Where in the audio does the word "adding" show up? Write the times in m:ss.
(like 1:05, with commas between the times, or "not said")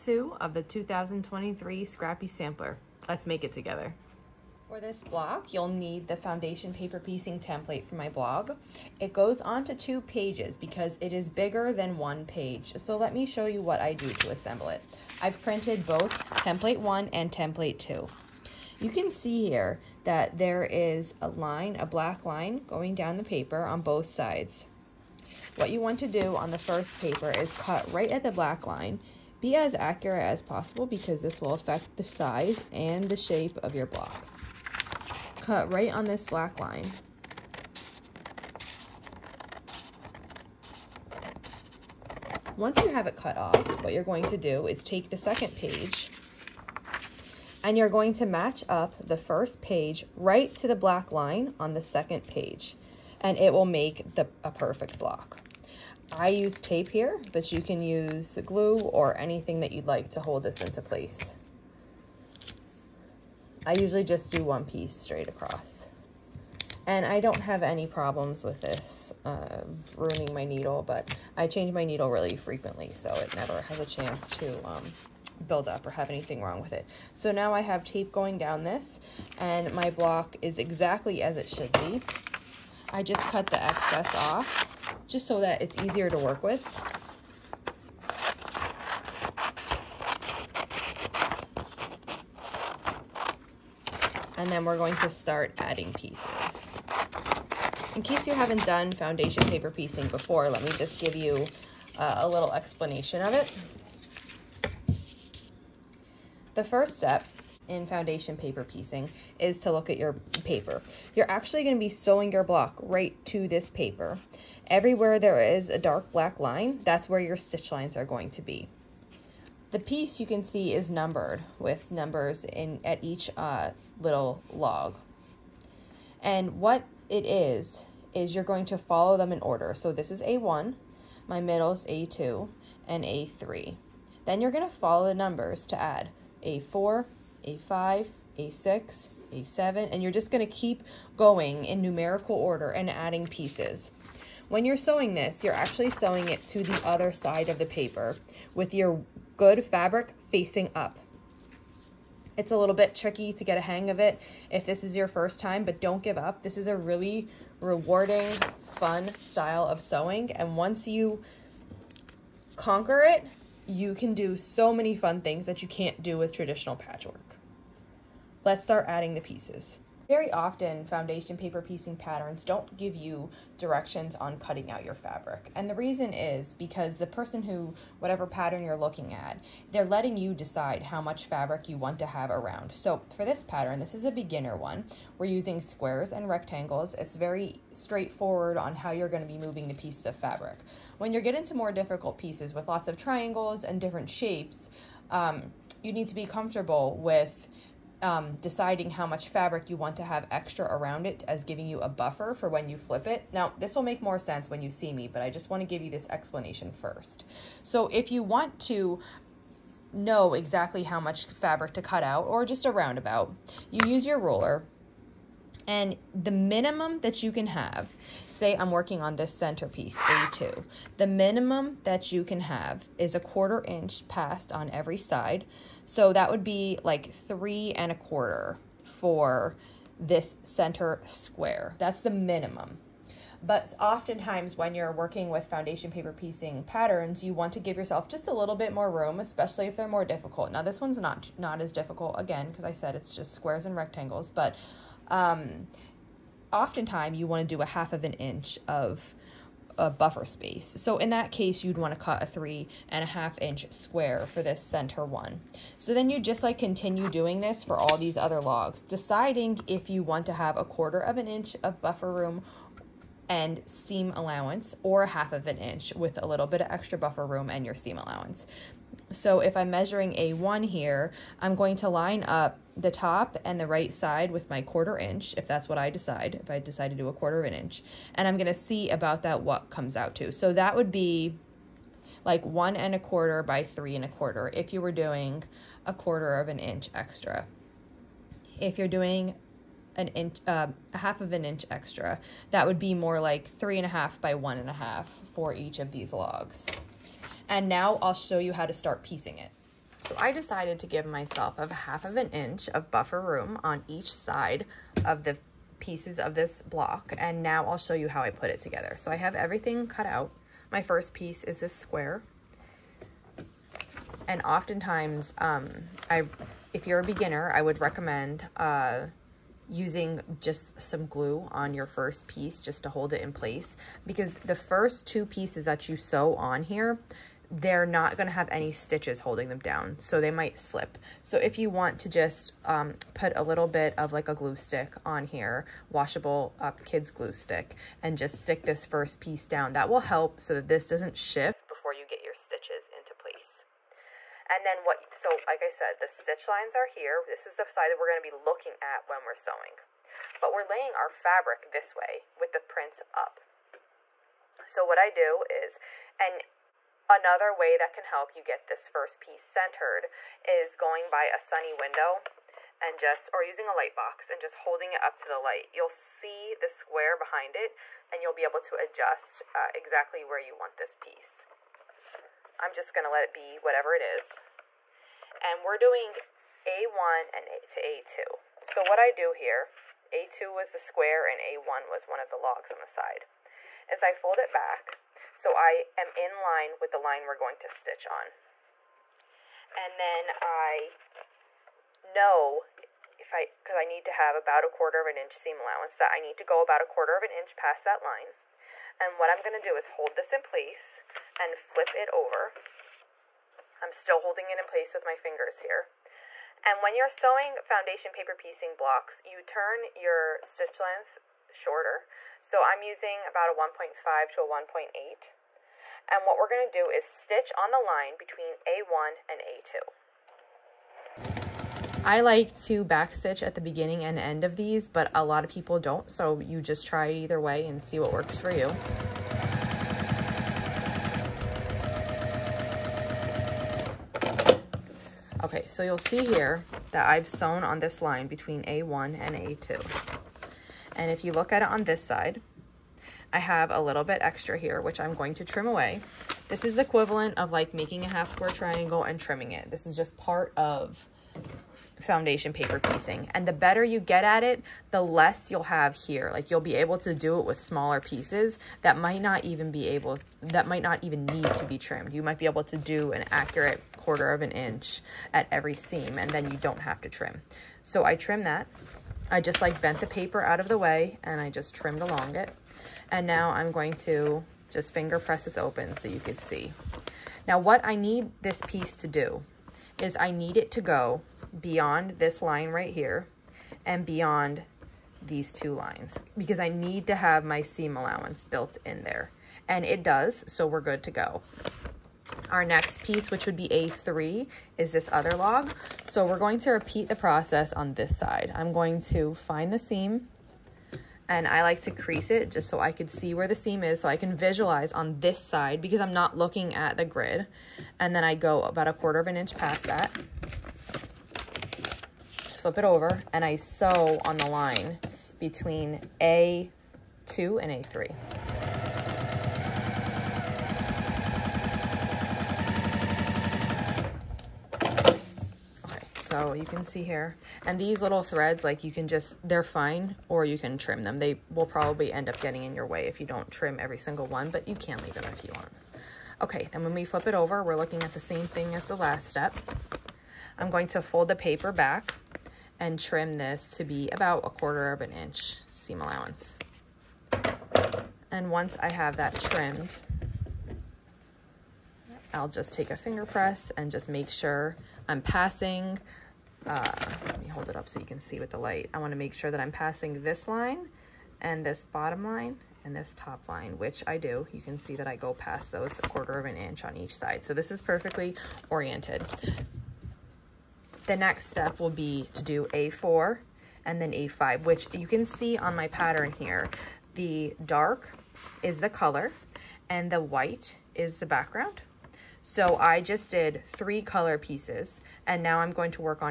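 1:35, 2:22, 2:48.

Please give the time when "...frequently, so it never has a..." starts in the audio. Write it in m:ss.
1:12.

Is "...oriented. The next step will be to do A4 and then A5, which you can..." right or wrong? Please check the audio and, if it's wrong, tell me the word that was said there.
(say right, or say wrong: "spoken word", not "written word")
right.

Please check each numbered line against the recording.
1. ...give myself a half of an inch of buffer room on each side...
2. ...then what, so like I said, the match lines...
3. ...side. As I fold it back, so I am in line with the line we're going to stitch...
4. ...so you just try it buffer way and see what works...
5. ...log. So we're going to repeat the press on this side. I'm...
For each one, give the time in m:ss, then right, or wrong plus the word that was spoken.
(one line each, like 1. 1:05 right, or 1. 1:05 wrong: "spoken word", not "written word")
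1. 5:00 right
2. 5:44 wrong: "stitch", not "match"
3. 6:22 right
4. 7:06 wrong: "either", not "buffer"
5. 8:15 wrong: "process", not "press".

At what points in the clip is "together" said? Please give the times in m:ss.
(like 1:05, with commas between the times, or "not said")
0:03, 5:08.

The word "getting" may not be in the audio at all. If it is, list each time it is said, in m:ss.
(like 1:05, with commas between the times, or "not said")
3:11, 8:52.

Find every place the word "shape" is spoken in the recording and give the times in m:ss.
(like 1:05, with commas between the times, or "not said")
0:33, 3:14.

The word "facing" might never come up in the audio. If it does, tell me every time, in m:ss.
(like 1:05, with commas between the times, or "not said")
2:30.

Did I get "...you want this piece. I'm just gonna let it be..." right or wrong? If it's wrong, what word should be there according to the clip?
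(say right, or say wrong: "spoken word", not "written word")
right.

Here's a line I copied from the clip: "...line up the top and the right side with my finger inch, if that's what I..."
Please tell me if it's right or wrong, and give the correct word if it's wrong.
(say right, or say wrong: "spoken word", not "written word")
wrong: "quarter", not "finger".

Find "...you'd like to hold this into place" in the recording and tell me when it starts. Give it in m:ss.
0:59.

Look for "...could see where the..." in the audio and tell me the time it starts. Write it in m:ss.
8:22.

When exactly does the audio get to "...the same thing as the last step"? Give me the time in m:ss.
8:58.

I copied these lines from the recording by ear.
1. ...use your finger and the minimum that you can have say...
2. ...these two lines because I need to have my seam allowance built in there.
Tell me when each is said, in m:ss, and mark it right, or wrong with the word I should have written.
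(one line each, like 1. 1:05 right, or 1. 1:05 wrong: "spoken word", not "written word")
1. 3:33 wrong: "ruler", not "finger"
2. 8:05 right.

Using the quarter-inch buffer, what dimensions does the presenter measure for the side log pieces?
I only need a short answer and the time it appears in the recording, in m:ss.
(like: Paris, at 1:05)
1 1/4 by 3 1/4, at 4:42.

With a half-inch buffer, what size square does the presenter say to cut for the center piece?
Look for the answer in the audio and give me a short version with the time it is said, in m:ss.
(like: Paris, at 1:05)
3 1/2 inch, at 4:12.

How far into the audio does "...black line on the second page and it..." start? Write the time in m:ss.
0:50.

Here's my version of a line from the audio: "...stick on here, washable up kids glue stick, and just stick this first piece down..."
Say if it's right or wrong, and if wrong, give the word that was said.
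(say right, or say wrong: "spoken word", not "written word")
right.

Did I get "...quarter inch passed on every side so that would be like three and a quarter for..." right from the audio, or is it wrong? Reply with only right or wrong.
right.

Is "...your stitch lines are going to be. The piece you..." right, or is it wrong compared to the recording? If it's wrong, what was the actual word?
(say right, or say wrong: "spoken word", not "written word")
right.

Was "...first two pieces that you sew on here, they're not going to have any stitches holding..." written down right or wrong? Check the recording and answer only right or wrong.
right.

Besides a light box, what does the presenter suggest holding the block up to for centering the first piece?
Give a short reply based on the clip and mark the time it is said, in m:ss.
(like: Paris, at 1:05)
a sunny window, at 6:01.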